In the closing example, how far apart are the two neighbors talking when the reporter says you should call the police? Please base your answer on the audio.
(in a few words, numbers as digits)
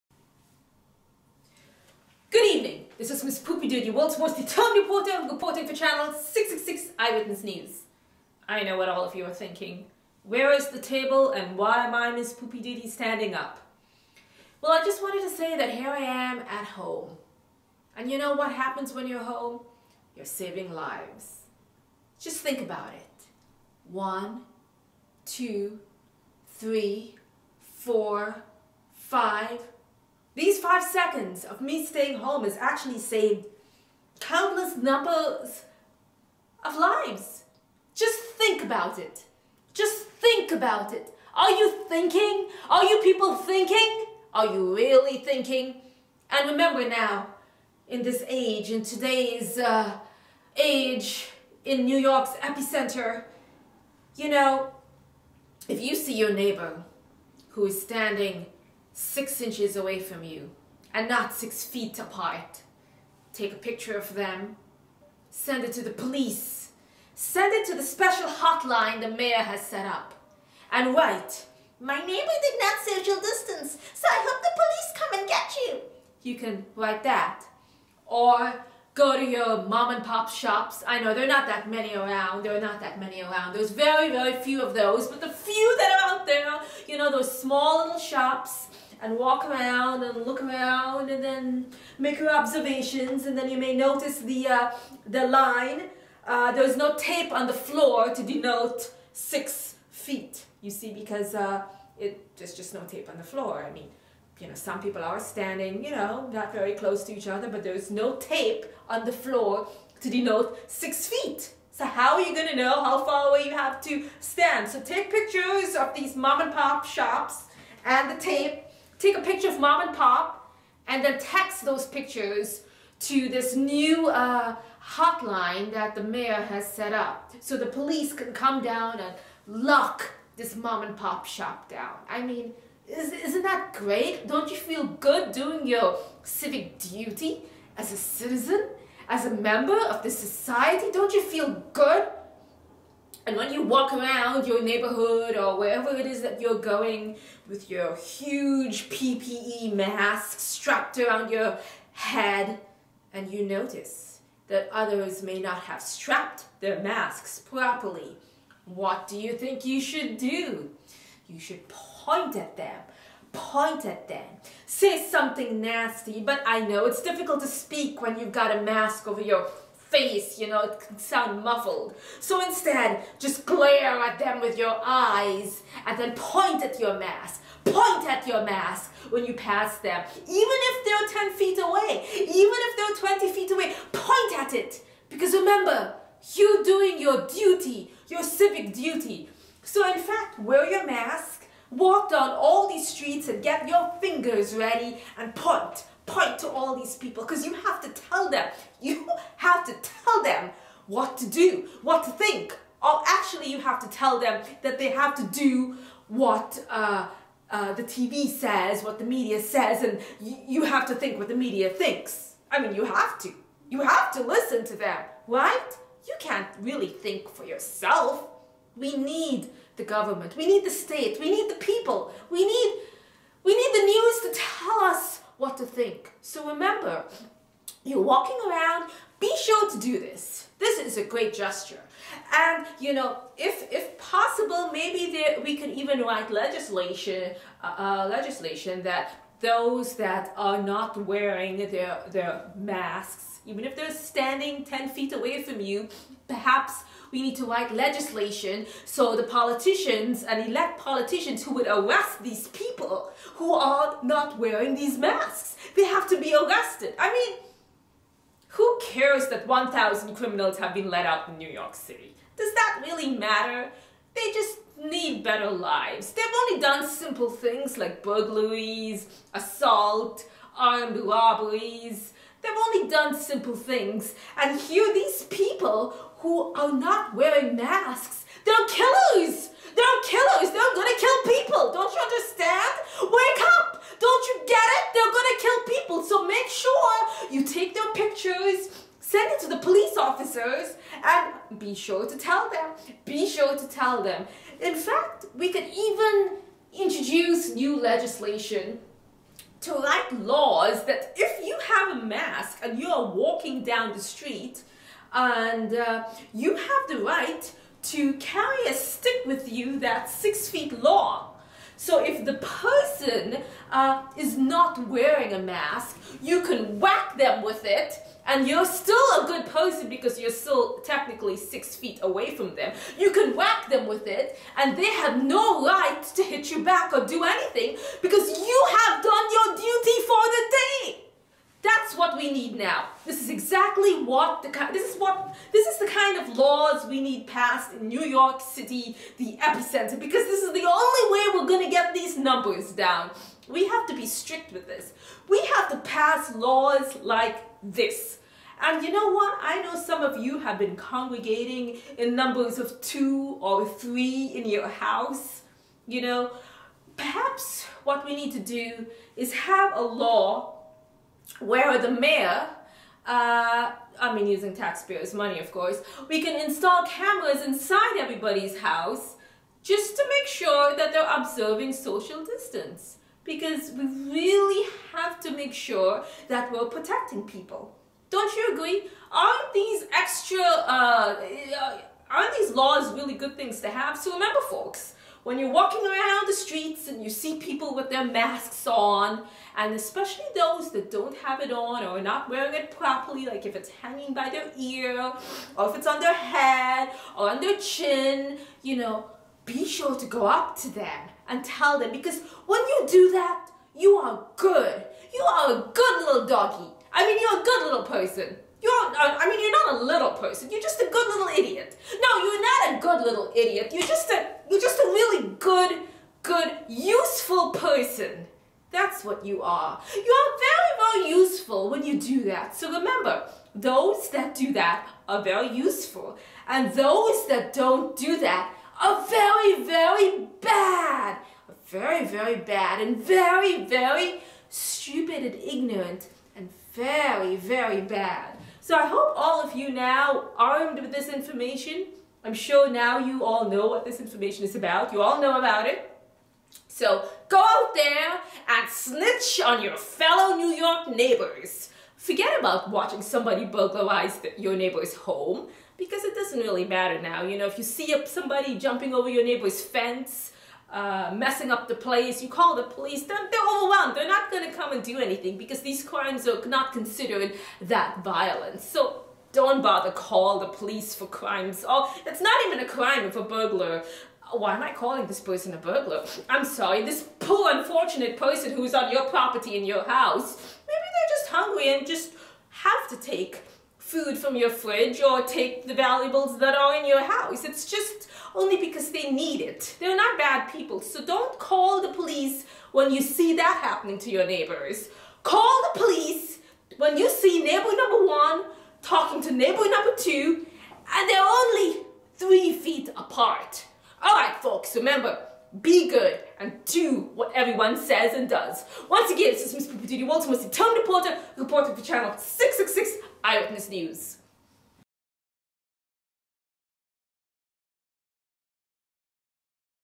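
3 feet.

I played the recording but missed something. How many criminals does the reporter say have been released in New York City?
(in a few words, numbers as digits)
1,000.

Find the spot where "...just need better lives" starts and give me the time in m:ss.
4:24.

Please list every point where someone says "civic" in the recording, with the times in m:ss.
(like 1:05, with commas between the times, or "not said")
2:16, 3:08.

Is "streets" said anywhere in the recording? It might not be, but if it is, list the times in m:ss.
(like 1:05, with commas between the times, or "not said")
3:12, 5:04, 6:26.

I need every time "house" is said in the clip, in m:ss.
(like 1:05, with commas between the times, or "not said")
5:54, 6:08, 7:59, 8:07.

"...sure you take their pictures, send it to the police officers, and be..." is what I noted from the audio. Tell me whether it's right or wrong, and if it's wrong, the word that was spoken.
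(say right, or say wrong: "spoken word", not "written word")
right.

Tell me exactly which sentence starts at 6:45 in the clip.
You are a good little doggy.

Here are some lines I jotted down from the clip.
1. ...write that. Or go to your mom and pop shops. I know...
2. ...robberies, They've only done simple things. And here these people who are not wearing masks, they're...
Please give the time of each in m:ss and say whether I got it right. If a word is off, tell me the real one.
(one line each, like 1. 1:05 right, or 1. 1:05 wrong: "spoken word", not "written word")
1. 1:16 right
2. 4:30 right.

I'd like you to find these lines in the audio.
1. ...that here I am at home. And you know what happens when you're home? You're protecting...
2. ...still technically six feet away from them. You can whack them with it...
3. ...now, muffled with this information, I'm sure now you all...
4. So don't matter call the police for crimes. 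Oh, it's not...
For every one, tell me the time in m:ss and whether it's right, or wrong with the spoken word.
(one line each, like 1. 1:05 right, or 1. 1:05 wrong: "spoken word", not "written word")
1. 0:15 wrong: "saving", not "protecting"
2. 5:20 right
3. 7:19 wrong: "armed", not "muffled"
4. 7:48 wrong: "bother", not "matter".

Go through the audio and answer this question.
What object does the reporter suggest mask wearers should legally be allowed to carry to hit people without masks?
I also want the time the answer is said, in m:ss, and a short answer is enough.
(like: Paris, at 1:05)
a stick, at 5:08.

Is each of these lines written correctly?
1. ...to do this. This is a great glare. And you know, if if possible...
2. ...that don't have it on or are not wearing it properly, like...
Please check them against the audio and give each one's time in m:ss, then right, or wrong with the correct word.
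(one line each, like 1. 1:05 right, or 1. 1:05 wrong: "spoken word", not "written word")
1. 3:49 wrong: "gesture", not "glare"
2. 6:30 right.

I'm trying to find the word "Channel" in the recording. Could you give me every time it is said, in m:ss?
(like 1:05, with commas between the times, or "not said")
0:05, 8:31.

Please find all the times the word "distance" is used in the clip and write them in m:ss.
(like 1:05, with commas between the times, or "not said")
1:13, 6:12.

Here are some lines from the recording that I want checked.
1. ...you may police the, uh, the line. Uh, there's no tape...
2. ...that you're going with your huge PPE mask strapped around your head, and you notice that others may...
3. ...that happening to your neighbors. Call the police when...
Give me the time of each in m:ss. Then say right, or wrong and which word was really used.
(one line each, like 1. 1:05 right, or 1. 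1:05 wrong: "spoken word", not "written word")
1. 1:33 wrong: "notice", not "police"
2. 2:26 right
3. 8:13 right.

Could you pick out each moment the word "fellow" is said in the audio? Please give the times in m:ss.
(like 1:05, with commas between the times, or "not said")
7:29.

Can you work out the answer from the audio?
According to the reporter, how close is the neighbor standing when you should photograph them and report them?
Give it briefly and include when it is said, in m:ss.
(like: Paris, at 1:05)
6 inches, at 0:58.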